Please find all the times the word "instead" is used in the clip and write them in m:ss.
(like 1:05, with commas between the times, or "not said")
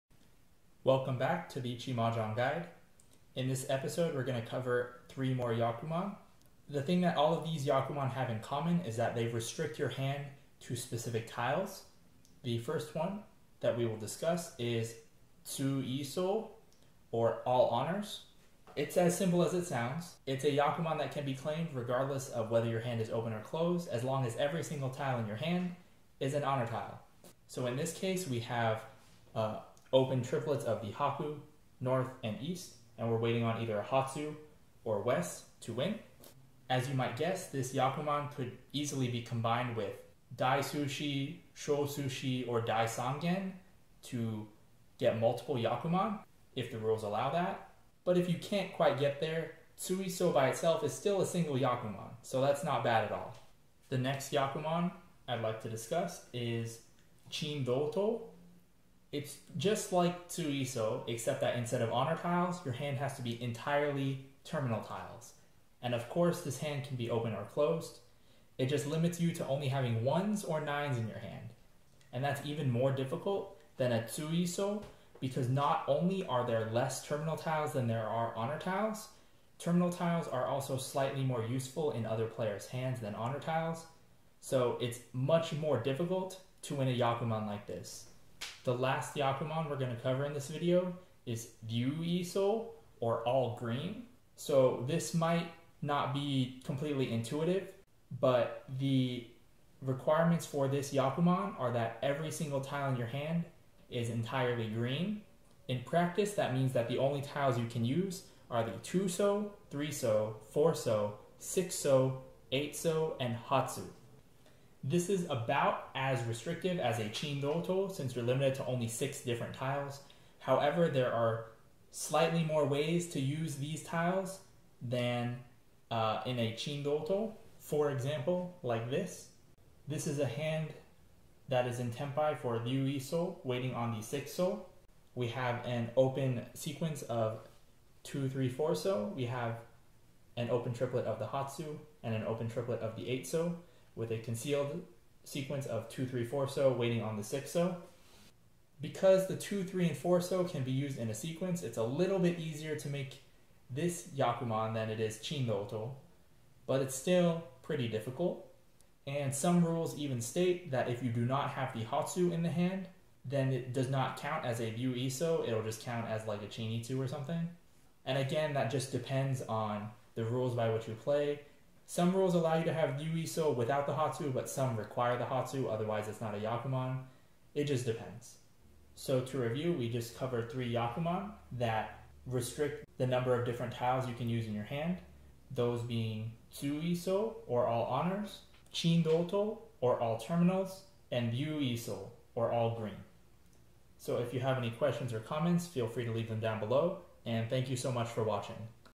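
1:01.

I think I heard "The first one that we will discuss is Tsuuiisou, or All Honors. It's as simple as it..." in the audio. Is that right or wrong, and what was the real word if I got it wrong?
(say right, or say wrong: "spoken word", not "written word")
right.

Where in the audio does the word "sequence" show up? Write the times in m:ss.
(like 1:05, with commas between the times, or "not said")
2:16, 2:25, 2:31.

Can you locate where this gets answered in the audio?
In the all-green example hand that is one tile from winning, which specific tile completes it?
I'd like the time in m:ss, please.
2:14.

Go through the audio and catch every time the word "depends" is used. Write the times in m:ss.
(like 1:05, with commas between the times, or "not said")
2:48, 2:57.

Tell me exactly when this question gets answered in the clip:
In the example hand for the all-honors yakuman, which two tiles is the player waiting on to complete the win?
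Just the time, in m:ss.
0:33.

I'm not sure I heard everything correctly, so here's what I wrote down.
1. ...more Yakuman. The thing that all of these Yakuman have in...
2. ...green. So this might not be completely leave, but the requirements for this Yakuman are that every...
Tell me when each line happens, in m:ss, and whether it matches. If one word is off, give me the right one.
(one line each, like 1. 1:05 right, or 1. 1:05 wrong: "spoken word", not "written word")
1. 0:05 right
2. 1:33 wrong: "intuitive", not "leave".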